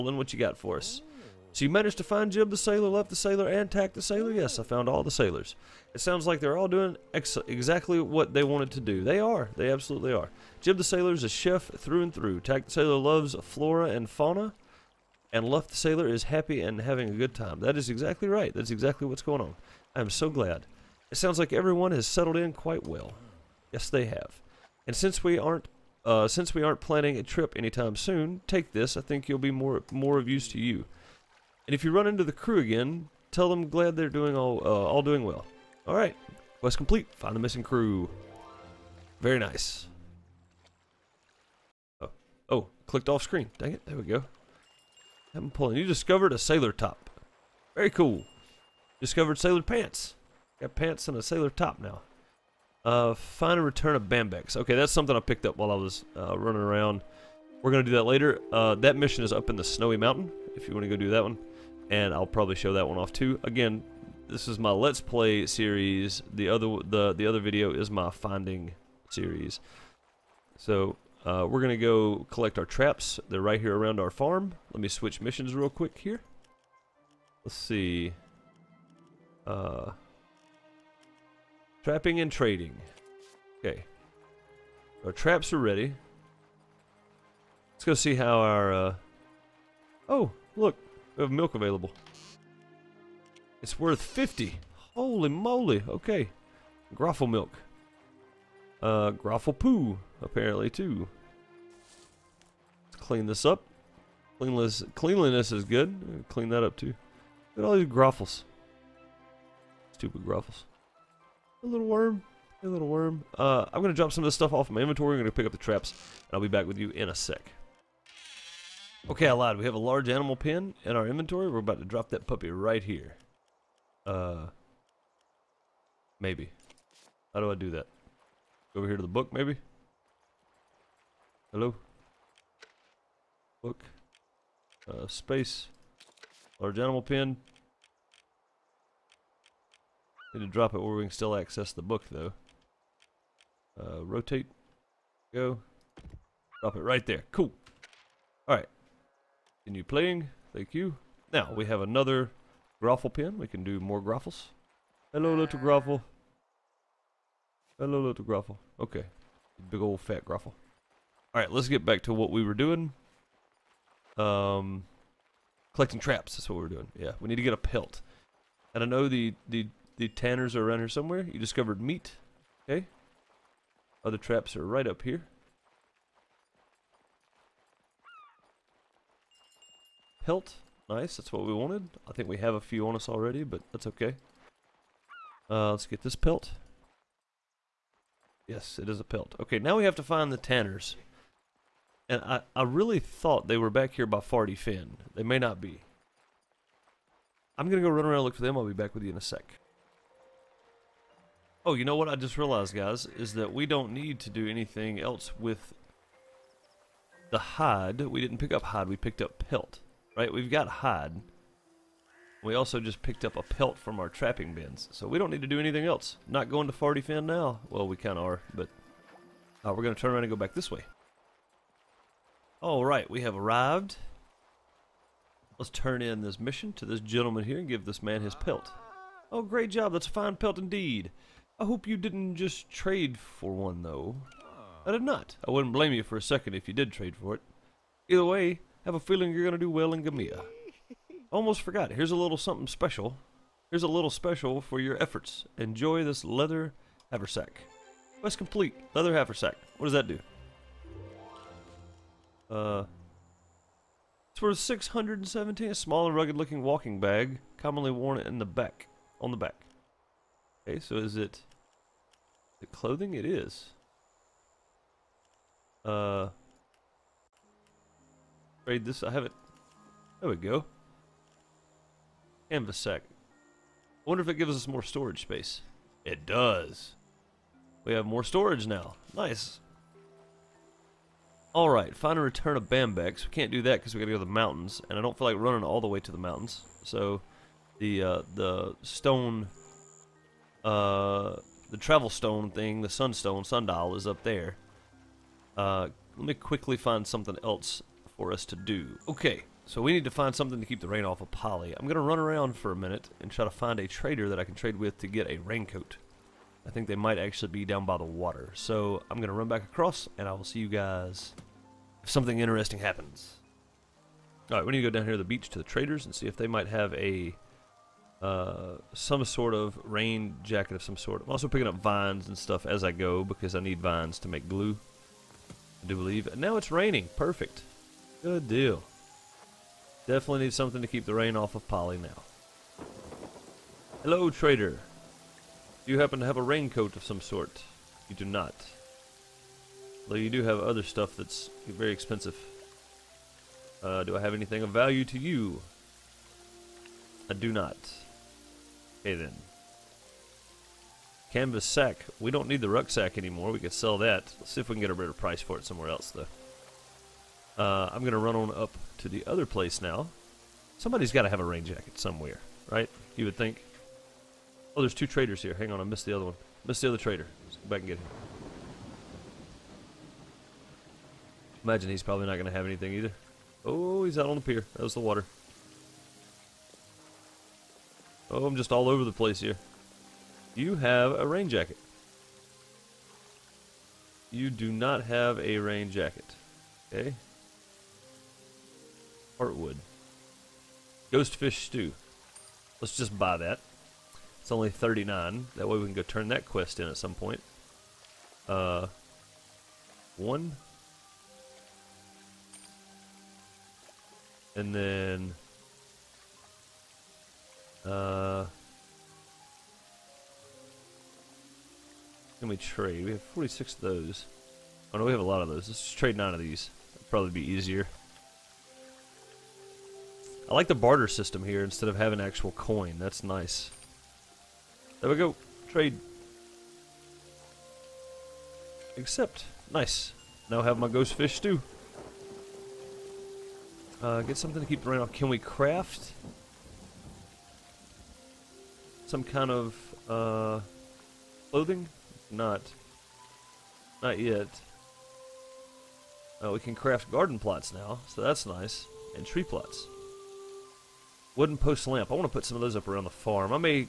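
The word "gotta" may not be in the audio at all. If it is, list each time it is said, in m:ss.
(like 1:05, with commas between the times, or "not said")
4:43.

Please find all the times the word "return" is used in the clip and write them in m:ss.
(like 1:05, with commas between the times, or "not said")
0:53, 4:42.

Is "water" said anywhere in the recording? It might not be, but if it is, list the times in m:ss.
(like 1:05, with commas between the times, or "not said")
5:08, 6:15.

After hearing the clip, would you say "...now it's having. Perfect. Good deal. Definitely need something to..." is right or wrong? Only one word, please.
wrong.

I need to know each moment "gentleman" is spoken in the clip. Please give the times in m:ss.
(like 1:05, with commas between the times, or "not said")
3:47.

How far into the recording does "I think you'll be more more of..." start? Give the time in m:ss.
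0:28.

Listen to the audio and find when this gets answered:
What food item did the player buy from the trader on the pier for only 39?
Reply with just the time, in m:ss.
6:31.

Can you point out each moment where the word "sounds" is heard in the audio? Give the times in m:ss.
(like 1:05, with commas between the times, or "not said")
0:06, 0:21.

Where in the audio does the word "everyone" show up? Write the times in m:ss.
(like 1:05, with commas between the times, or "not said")
0:21.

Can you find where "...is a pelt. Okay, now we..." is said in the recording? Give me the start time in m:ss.
3:08.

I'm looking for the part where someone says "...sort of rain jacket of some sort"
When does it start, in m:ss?
5:19.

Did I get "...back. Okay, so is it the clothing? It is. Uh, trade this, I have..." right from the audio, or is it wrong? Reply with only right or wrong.
right.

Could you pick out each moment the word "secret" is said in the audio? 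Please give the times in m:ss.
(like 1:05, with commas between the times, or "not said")
not said.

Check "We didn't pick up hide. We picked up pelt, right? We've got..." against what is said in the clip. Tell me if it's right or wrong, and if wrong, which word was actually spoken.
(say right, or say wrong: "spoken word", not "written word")
right.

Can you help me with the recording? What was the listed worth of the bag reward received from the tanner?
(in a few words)
617.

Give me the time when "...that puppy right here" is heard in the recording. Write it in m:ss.
2:02.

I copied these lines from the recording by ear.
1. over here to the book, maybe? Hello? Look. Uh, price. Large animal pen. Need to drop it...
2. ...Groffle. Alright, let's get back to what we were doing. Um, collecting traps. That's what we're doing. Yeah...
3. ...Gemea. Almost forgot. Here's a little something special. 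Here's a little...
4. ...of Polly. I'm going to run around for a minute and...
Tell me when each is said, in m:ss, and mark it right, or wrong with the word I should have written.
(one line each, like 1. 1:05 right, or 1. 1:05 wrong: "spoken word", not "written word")
1. 2:08 wrong: "space", not "price"
2. 2:40 right
3. 4:00 right
4. 5:01 right.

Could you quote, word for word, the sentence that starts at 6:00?
Somebody's got to have a rain jacket somewhere, right?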